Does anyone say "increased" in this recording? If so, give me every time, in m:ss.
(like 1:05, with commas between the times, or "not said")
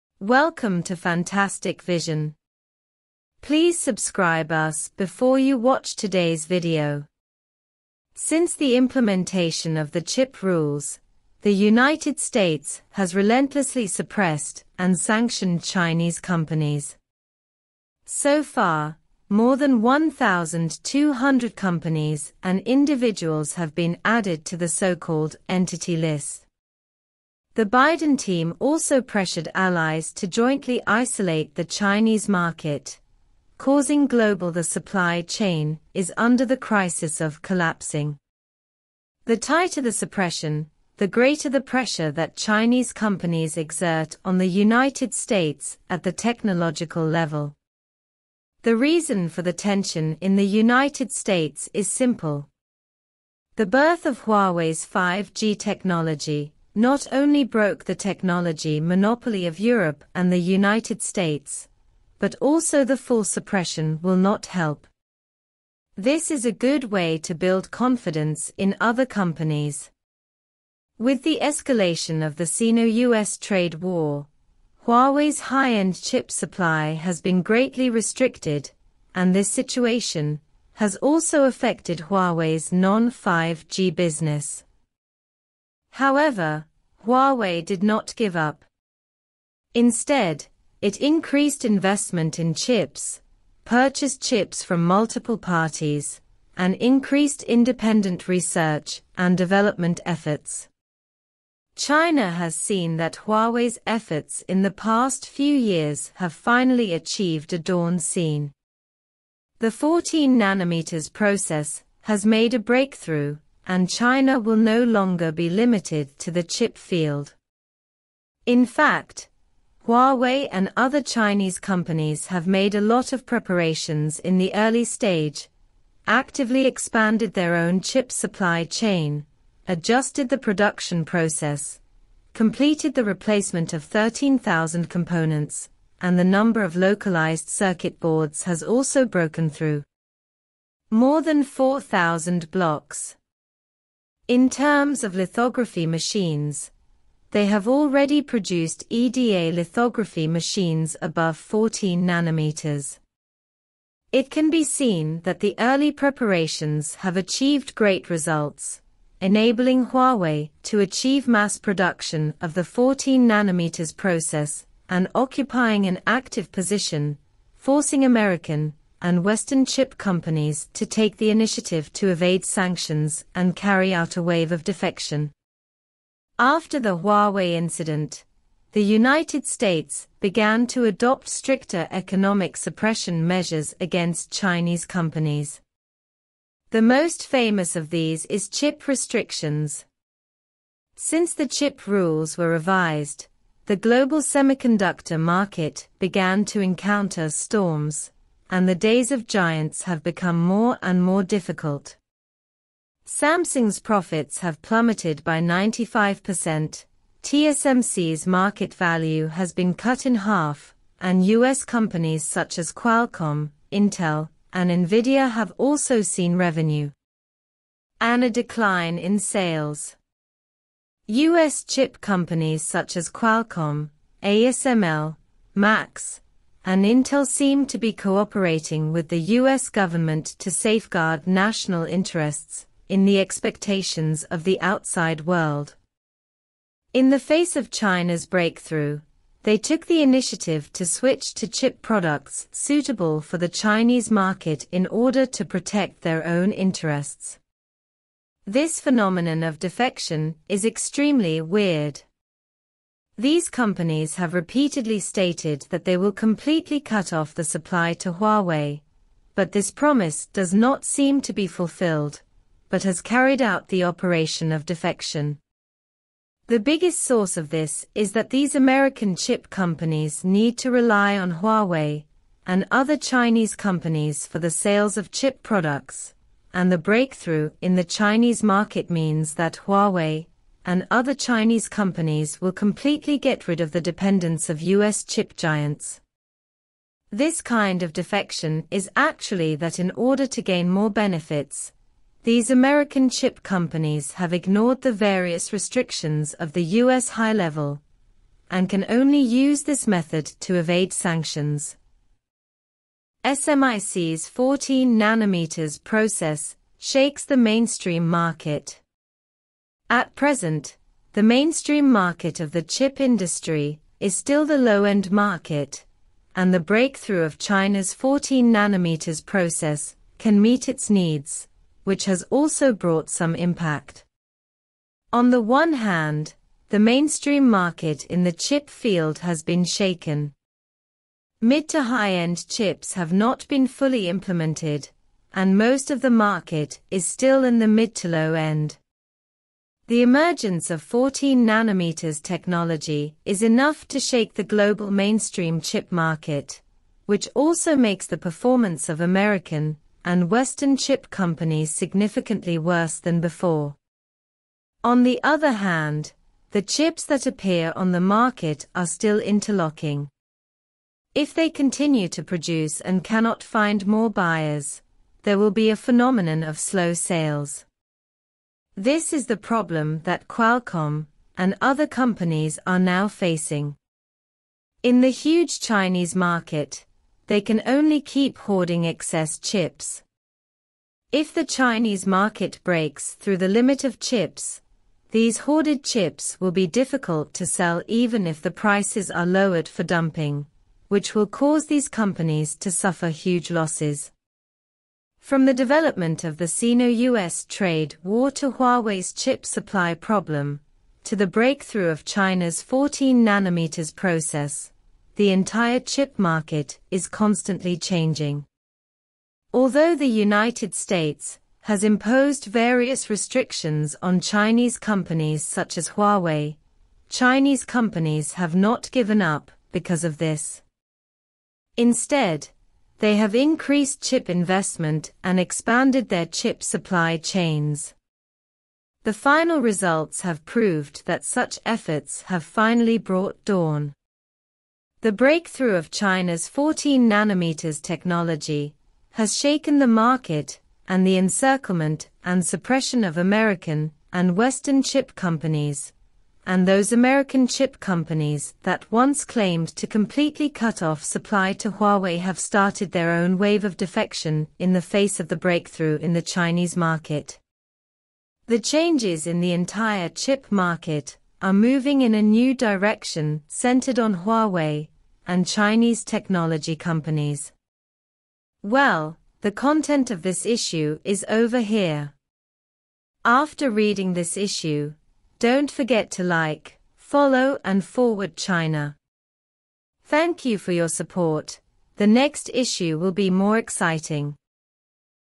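1:31, 1:36, 7:03.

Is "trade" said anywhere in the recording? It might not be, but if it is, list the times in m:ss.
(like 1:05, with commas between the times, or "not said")
1:13, 6:37.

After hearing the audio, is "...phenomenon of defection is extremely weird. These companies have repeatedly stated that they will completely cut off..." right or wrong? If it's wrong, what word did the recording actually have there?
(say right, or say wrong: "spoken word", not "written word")
right.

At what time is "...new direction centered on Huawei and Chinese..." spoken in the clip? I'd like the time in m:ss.
7:42.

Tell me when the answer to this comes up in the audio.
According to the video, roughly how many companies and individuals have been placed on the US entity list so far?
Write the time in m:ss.
0:19.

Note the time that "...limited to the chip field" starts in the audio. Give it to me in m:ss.
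1:55.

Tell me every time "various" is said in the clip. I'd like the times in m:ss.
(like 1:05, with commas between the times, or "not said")
4:54, 6:52.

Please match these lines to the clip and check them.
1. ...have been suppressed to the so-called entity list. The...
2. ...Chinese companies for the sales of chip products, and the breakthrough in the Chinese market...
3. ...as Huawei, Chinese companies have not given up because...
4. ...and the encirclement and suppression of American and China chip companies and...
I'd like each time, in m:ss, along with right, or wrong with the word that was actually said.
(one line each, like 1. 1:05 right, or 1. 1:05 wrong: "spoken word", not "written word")
1. 0:23 wrong: "added", not "suppressed"
2. 4:32 right
3. 6:55 right
4. 7:20 wrong: "Western", not "China".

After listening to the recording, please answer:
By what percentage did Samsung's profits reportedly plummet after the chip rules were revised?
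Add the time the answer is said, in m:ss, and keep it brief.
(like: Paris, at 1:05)
95%, at 3:25.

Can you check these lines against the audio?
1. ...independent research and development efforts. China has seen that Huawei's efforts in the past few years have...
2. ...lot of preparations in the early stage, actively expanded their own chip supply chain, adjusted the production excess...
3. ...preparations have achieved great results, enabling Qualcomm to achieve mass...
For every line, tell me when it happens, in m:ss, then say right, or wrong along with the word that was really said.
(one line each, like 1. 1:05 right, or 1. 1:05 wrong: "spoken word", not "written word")
1. 1:37 right
2. 2:02 wrong: "process", not "excess"
3. 2:35 wrong: "Huawei", not "Qualcomm".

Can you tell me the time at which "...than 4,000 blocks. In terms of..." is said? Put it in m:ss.
2:21.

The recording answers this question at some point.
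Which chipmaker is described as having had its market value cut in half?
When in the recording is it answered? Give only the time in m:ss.
3:27.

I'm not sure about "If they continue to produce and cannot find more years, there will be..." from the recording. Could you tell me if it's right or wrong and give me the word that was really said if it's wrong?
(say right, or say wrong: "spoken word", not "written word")
wrong: "buyers", not "years".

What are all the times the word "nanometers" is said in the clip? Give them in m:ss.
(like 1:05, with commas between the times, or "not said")
1:50, 2:32, 2:43, 5:04, 5:18, 5:41, 6:43, 7:17.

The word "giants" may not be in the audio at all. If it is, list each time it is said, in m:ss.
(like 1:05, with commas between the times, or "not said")
3:19, 4:45.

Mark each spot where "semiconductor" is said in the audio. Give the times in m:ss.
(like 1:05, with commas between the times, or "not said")
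3:14.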